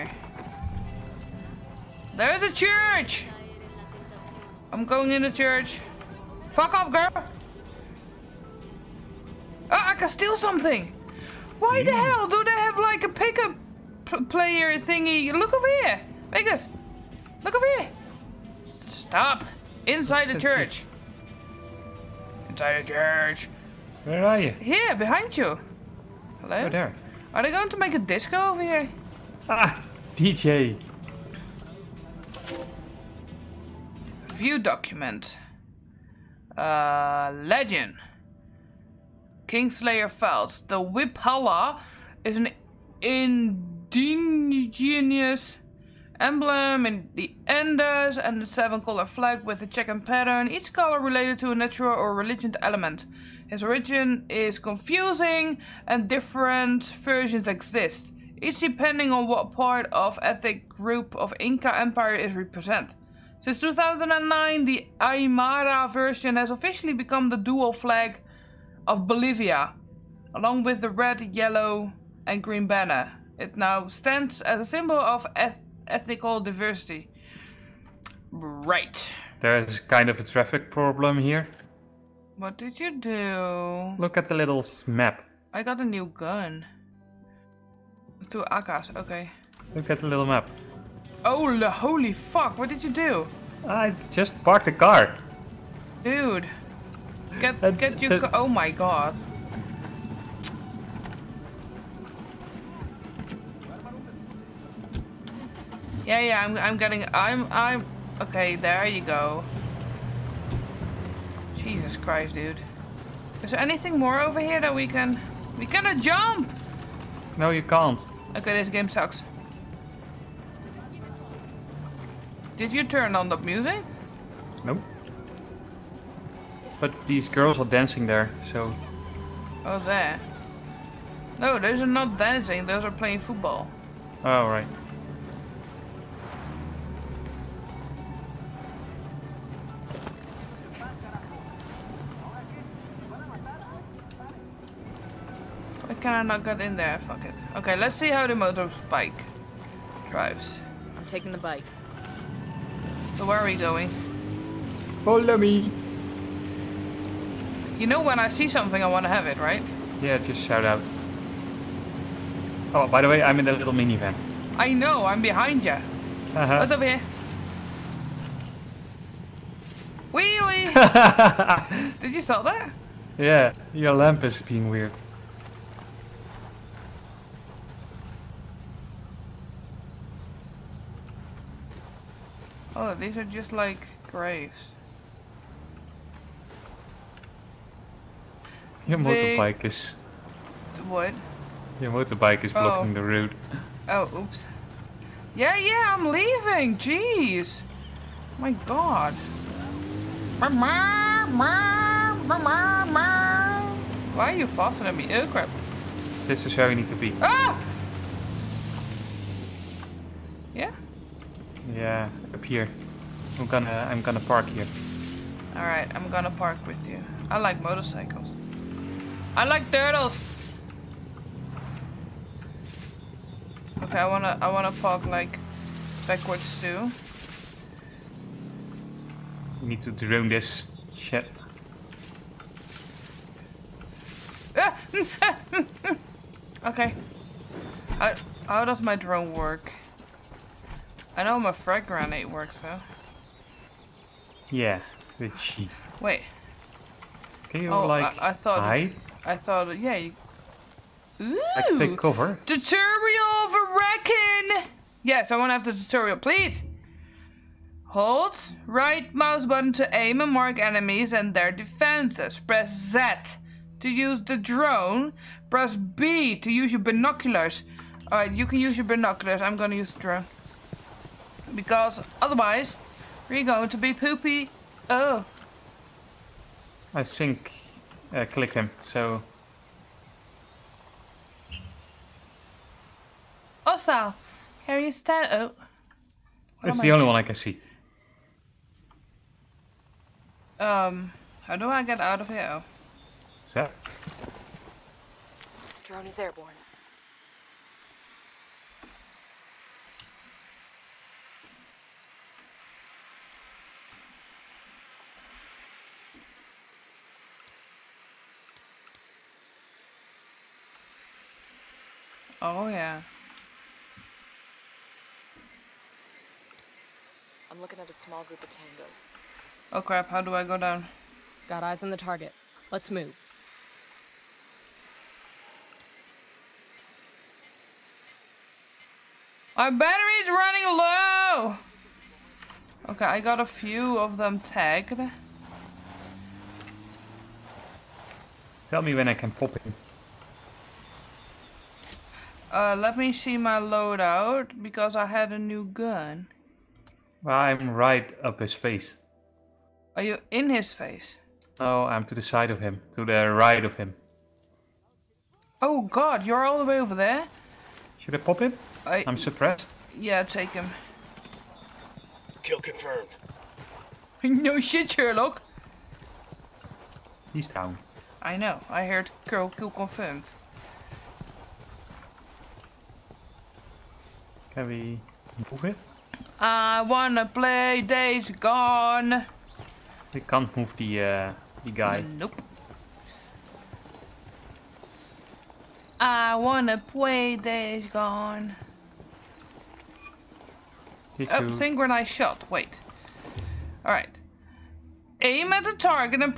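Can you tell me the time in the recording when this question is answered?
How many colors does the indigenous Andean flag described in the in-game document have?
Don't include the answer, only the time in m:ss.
0:48.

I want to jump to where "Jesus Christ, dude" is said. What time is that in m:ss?
1:51.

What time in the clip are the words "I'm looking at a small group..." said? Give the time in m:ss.
5:17.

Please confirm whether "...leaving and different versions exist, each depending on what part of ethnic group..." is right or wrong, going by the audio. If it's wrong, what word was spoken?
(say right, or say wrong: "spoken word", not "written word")
wrong: "confusing", not "leaving".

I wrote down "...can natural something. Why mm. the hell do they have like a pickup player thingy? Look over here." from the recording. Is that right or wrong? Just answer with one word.
wrong.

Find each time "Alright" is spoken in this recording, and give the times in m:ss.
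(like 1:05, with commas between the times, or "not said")
3:35, 4:28.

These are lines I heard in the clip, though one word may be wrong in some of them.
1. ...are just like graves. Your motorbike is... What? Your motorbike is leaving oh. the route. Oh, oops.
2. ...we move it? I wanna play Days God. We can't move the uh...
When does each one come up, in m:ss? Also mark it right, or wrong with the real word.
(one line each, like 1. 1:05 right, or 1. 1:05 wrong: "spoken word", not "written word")
1. 3:03 wrong: "blocking", not "leaving"
2. 6:14 wrong: "Gone", not "God".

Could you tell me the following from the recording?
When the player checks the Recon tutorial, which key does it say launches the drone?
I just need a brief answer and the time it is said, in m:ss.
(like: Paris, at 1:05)
Z, at 4:22.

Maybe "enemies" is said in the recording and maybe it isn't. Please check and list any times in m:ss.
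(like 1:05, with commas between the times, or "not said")
4:20.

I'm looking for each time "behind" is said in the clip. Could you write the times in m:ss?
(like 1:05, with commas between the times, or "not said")
0:24, 2:45.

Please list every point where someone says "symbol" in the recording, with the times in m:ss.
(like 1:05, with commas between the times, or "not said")
1:14.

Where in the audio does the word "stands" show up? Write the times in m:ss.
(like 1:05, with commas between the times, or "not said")
1:13, 4:44.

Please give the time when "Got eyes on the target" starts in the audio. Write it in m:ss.
5:21.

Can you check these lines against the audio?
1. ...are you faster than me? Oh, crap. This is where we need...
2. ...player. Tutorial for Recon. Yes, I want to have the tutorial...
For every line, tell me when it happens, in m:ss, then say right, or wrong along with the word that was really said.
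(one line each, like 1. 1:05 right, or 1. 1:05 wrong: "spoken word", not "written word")
1. 3:24 right
2. 4:11 wrong: "cover", not "player".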